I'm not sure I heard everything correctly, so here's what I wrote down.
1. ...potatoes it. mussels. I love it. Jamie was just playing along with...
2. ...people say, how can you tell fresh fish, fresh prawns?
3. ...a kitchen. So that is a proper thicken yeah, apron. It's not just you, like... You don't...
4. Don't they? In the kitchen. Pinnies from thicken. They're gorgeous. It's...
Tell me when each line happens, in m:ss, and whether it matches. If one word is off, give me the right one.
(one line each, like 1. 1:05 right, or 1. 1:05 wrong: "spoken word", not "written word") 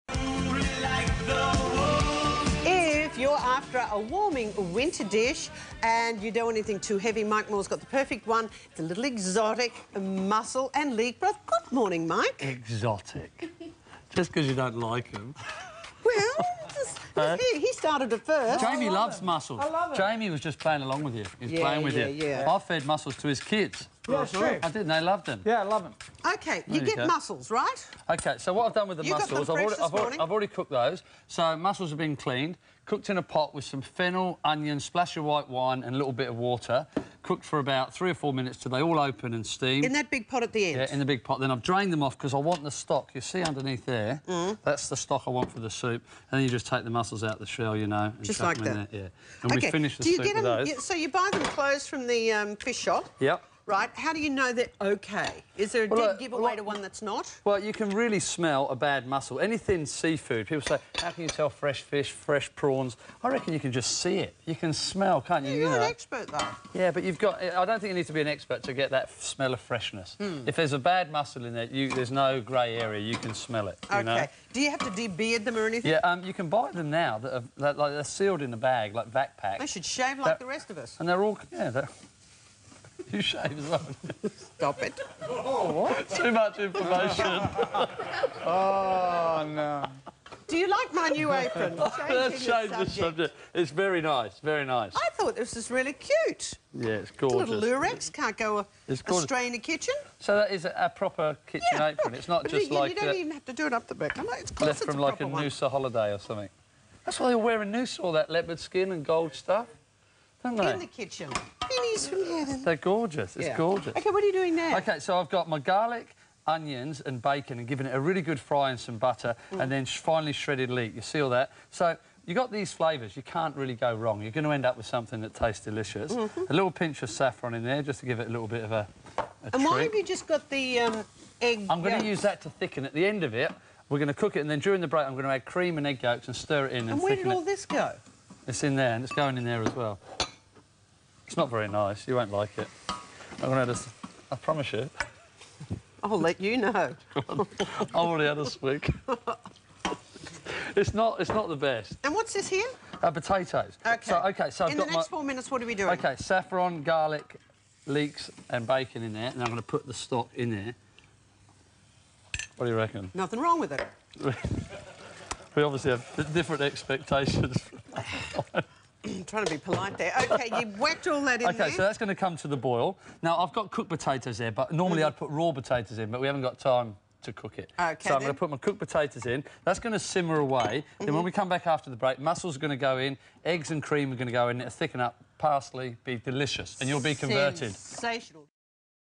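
1. 0:18 wrong: "loves", not "potatoes"
2. 1:00 right
3. 1:39 wrong: "kitchen", not "thicken"
4. 1:50 wrong: "heaven", not "thicken".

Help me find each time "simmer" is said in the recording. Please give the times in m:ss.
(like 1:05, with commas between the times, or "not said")
2:59.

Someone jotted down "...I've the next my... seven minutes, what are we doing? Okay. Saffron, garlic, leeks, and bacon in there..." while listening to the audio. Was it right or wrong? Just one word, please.
wrong.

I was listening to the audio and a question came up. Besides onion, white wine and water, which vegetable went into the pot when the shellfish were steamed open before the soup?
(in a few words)
fennel.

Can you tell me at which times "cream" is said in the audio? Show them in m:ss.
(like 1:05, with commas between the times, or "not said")
2:15, 3:03.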